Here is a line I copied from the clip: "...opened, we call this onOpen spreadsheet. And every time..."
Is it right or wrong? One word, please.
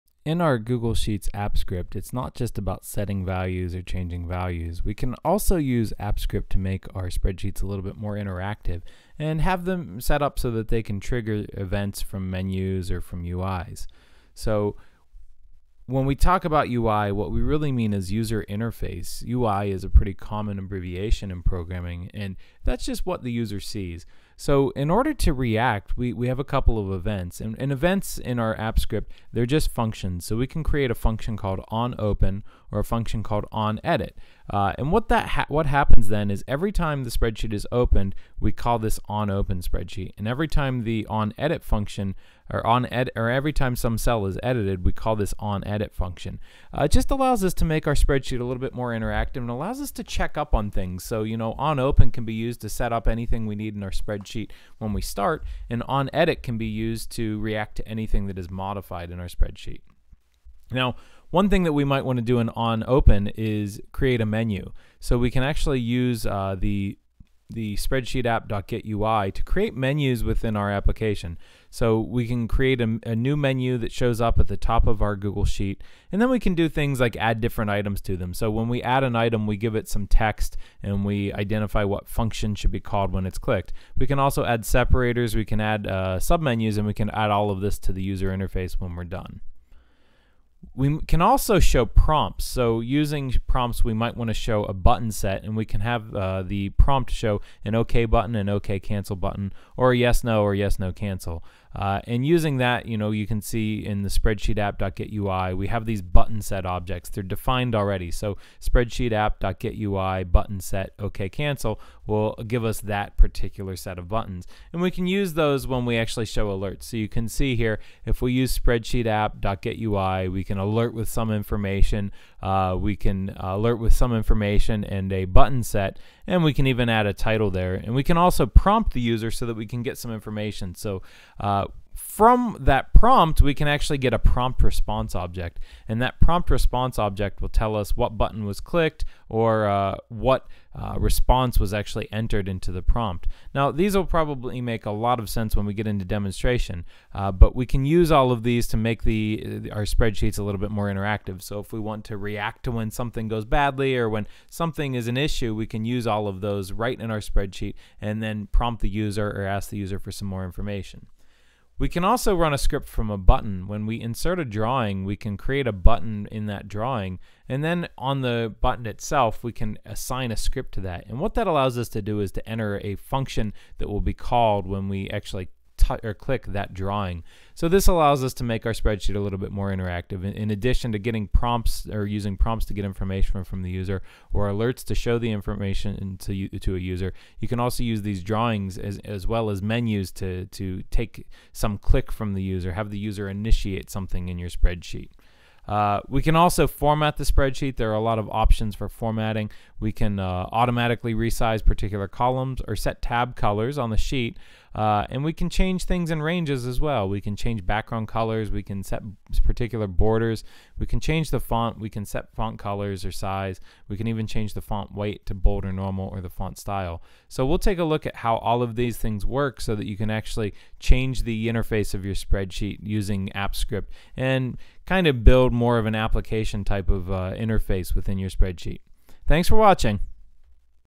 right.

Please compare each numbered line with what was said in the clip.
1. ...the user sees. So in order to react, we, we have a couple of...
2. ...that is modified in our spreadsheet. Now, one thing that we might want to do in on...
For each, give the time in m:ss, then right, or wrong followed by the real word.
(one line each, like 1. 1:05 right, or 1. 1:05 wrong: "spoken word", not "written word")
1. 0:23 right
2. 0:58 right.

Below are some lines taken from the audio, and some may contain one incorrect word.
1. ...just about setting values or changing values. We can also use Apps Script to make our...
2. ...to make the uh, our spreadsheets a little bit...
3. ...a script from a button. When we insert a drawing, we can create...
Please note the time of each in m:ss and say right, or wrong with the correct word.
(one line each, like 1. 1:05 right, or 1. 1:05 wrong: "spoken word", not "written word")
1. 0:02 right
2. 2:28 right
3. 2:42 right.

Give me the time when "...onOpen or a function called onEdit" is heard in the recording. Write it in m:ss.
0:31.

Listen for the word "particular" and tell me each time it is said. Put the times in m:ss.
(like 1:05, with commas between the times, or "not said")
1:53, 3:21, 3:29.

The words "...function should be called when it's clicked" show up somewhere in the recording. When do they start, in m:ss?
1:22.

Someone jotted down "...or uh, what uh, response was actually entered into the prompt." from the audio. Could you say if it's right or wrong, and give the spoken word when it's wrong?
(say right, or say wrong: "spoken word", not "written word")
right.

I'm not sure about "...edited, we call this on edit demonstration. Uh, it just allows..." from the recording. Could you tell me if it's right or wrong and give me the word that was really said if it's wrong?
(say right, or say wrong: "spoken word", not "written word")
wrong: "function", not "demonstration".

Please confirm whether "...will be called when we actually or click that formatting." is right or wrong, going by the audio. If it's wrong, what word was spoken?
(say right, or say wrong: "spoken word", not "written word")
wrong: "drawing", not "formatting".